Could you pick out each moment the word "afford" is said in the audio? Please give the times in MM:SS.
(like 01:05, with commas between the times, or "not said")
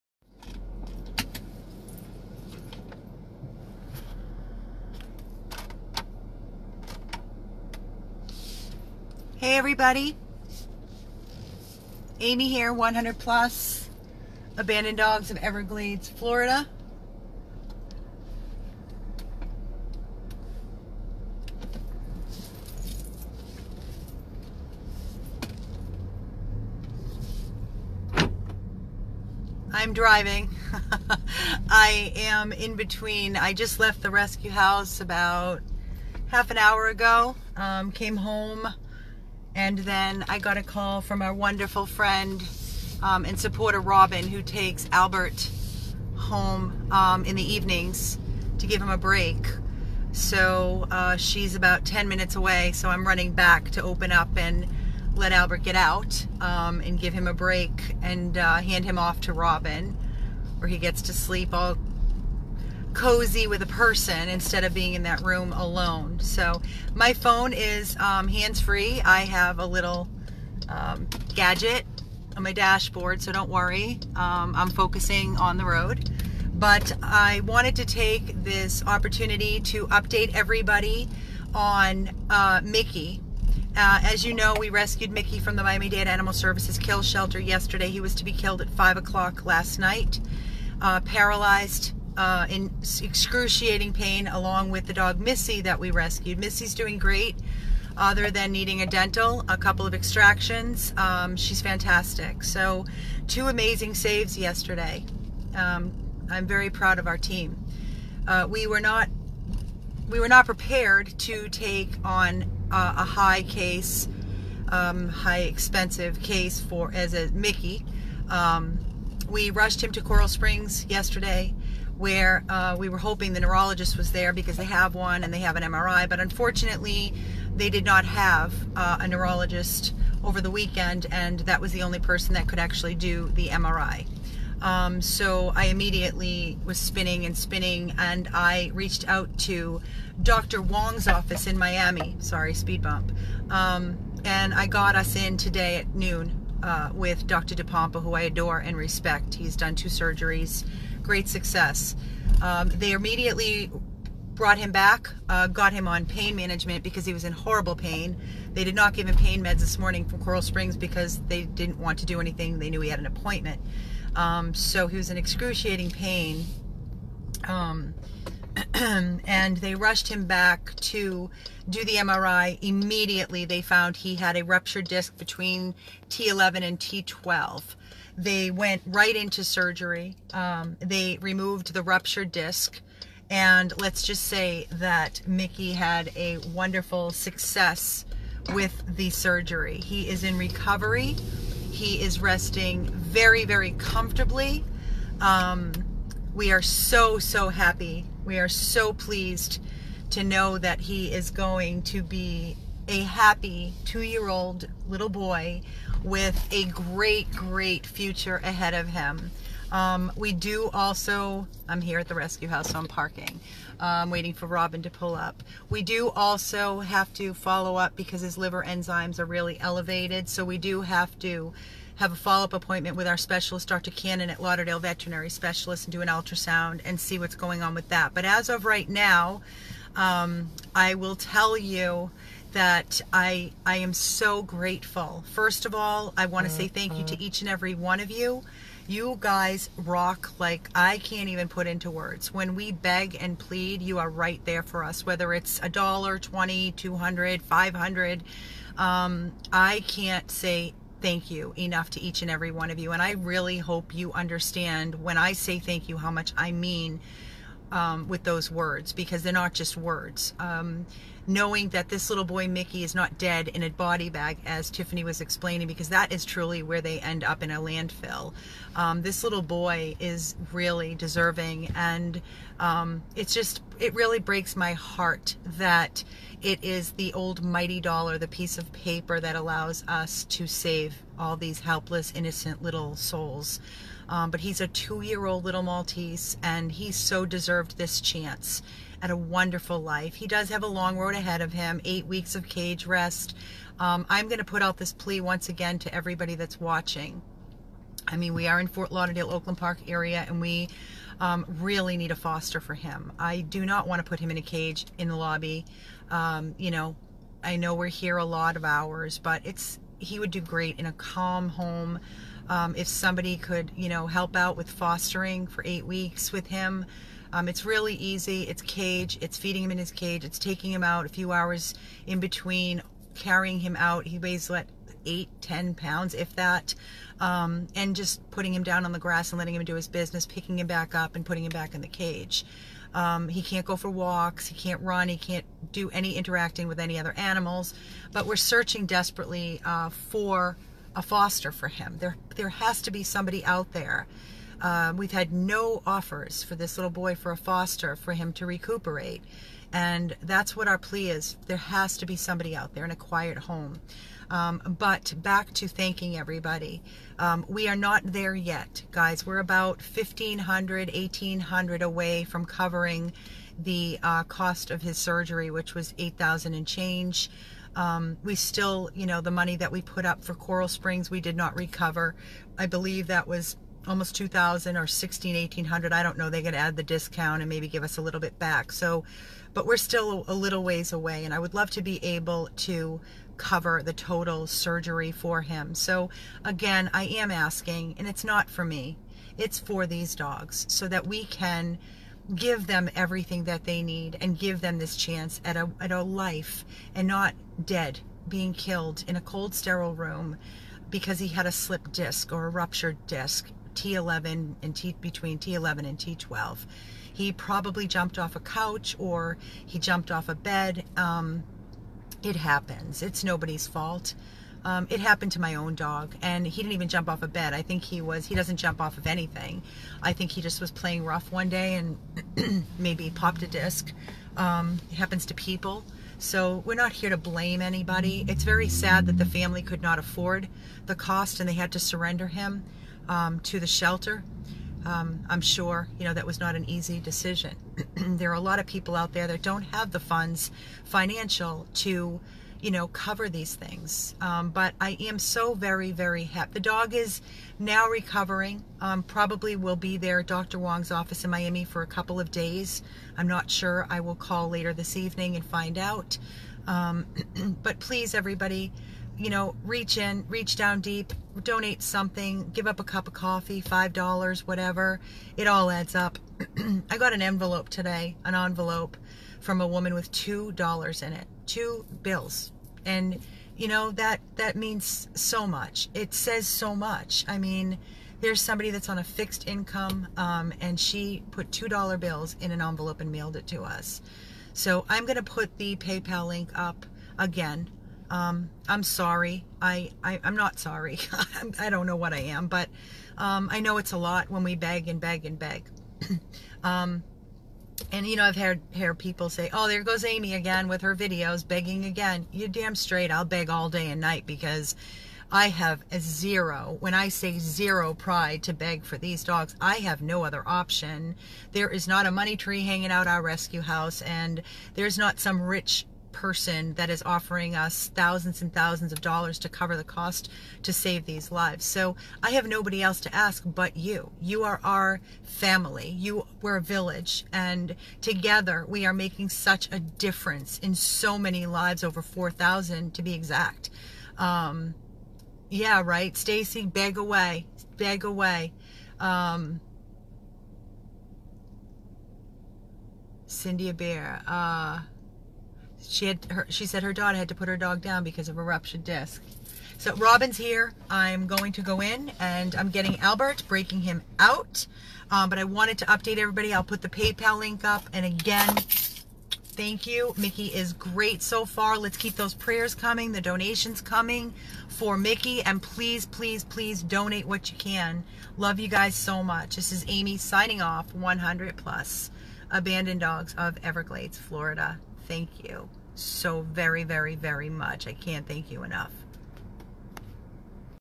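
07:09.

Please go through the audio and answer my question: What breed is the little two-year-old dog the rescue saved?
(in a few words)
Maltese.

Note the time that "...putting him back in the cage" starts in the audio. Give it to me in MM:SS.
05:31.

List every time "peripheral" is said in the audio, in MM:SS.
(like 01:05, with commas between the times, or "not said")
not said.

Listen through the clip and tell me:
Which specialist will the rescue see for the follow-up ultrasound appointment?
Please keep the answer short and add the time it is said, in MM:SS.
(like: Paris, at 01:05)
Dr. Cannon, at 03:43.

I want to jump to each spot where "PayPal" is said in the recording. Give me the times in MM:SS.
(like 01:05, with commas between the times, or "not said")
08:05, 09:16.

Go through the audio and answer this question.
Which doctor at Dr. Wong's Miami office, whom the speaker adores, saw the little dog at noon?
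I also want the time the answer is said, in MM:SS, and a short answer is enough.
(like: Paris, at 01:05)
Dr. DePompa, at 02:27.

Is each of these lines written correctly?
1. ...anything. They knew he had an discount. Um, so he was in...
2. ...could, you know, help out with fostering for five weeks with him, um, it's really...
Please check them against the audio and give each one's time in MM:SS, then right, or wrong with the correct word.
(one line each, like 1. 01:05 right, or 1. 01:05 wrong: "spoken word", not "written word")
1. 02:42 wrong: "appointment", not "discount"
2. 05:13 wrong: "eight", not "five".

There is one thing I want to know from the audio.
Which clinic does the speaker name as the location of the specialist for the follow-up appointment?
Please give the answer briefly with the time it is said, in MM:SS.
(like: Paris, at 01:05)
Lauderdale Veterinary Specialist, at 03:44.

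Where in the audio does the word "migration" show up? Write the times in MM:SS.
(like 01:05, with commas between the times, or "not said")
not said.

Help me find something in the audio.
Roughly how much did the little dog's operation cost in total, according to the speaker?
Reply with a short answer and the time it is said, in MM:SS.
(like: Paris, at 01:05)
8,000 and change, at 06:05.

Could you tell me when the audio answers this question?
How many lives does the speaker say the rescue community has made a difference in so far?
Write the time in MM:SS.
08:51.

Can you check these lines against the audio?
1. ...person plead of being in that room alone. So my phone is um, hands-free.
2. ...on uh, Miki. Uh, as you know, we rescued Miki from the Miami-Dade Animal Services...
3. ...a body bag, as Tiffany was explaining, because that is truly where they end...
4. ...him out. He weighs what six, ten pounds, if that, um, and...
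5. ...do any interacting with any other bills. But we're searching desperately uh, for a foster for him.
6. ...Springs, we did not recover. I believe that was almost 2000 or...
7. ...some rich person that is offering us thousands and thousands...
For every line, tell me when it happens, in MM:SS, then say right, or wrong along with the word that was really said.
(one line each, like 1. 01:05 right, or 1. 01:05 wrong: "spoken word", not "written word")
1. 01:03 wrong: "instead", not "plead"
2. 01:21 right
3. 04:23 right
4. 05:23 wrong: "eight", not "six"
5. 05:35 wrong: "animals", not "bills"
6. 06:10 right
7. 08:35 right.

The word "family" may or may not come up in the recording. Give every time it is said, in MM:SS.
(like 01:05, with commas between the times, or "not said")
07:09, 08:45.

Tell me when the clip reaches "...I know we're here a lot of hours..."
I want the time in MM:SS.
05:07.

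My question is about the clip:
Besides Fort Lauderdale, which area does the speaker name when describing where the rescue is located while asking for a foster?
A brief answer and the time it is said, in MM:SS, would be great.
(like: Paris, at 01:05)
Oakland Park, at 04:59.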